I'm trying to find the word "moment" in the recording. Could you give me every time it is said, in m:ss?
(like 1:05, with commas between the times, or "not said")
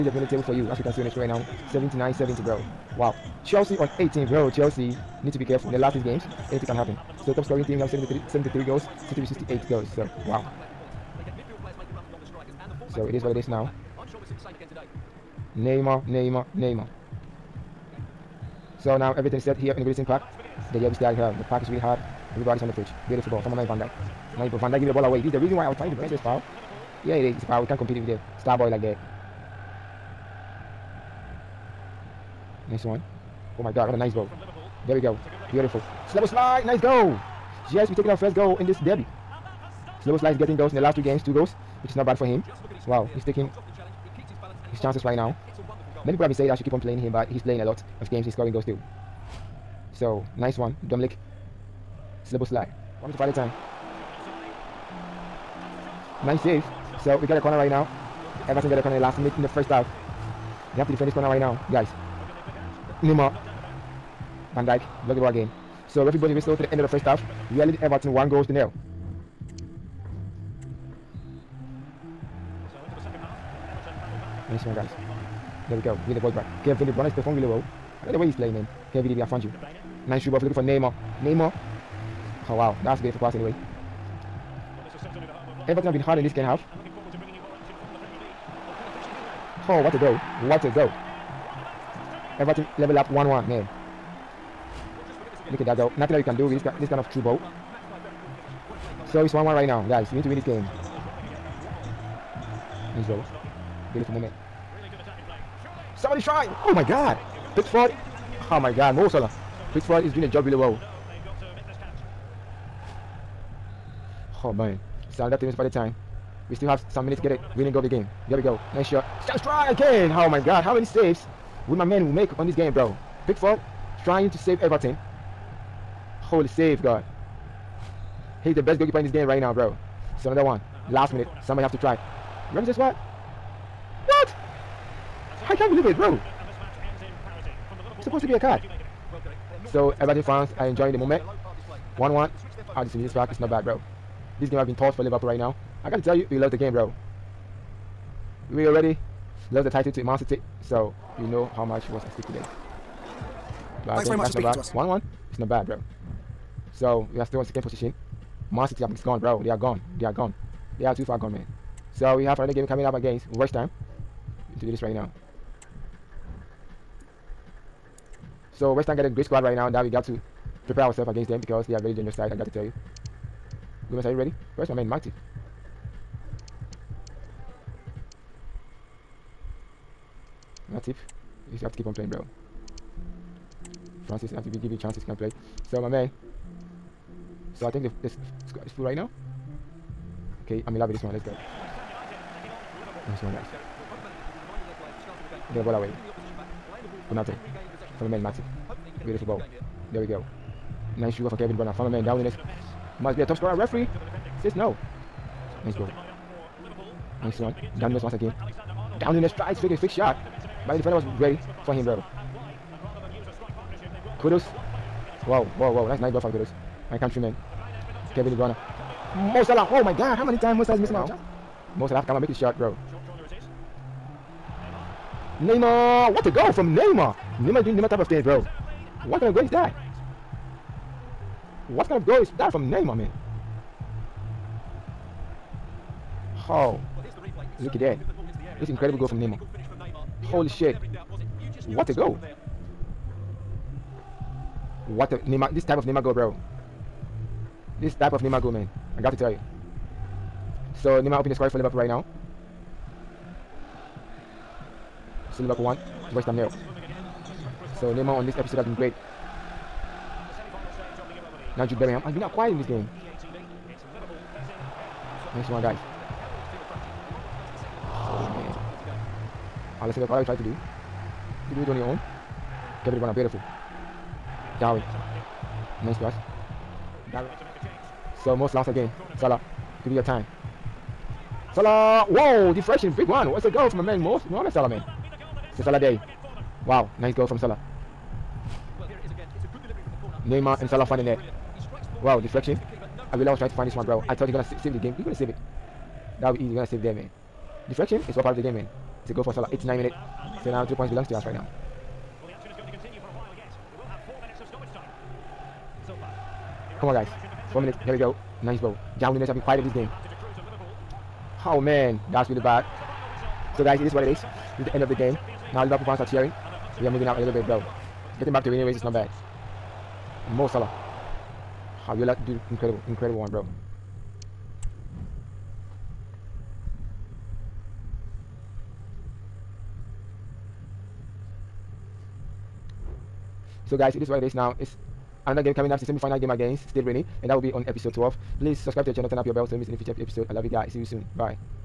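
1:44, 2:20.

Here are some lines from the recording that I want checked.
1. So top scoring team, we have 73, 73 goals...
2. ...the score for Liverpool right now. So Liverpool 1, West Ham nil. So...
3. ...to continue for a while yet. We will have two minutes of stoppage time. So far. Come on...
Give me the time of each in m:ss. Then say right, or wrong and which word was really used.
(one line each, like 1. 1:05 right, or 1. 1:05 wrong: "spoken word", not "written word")
1. 0:07 right
2. 4:11 right
3. 5:02 wrong: "four", not "two".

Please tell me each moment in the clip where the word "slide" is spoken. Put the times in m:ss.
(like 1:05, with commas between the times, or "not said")
0:36, 0:52.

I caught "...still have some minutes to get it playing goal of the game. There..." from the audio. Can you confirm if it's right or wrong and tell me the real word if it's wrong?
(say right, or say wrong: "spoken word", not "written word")
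wrong: "winning", not "playing".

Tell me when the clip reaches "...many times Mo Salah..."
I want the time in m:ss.
3:40.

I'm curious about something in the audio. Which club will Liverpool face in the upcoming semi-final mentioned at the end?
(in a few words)
Stade Rennais.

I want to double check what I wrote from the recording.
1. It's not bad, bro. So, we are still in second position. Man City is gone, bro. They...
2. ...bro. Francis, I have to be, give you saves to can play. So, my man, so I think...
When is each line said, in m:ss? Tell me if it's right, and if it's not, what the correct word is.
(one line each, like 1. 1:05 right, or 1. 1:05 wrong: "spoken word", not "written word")
1. 2:35 right
2. 3:02 wrong: "chances", not "saves".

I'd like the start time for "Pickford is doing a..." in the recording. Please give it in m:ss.
1:49.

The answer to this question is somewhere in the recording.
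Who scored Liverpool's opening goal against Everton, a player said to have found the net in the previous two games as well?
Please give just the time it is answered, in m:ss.
0:40.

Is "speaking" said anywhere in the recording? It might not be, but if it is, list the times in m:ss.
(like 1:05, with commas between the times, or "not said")
2:34.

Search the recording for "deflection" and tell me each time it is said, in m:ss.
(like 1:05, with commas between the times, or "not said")
4:42, 4:52, 4:57.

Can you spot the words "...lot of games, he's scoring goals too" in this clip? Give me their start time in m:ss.
0:47.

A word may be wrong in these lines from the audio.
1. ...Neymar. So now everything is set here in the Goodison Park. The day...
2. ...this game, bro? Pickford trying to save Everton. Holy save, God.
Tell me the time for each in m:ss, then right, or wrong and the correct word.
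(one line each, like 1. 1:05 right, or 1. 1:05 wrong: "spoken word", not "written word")
1. 0:16 right
2. 2:02 right.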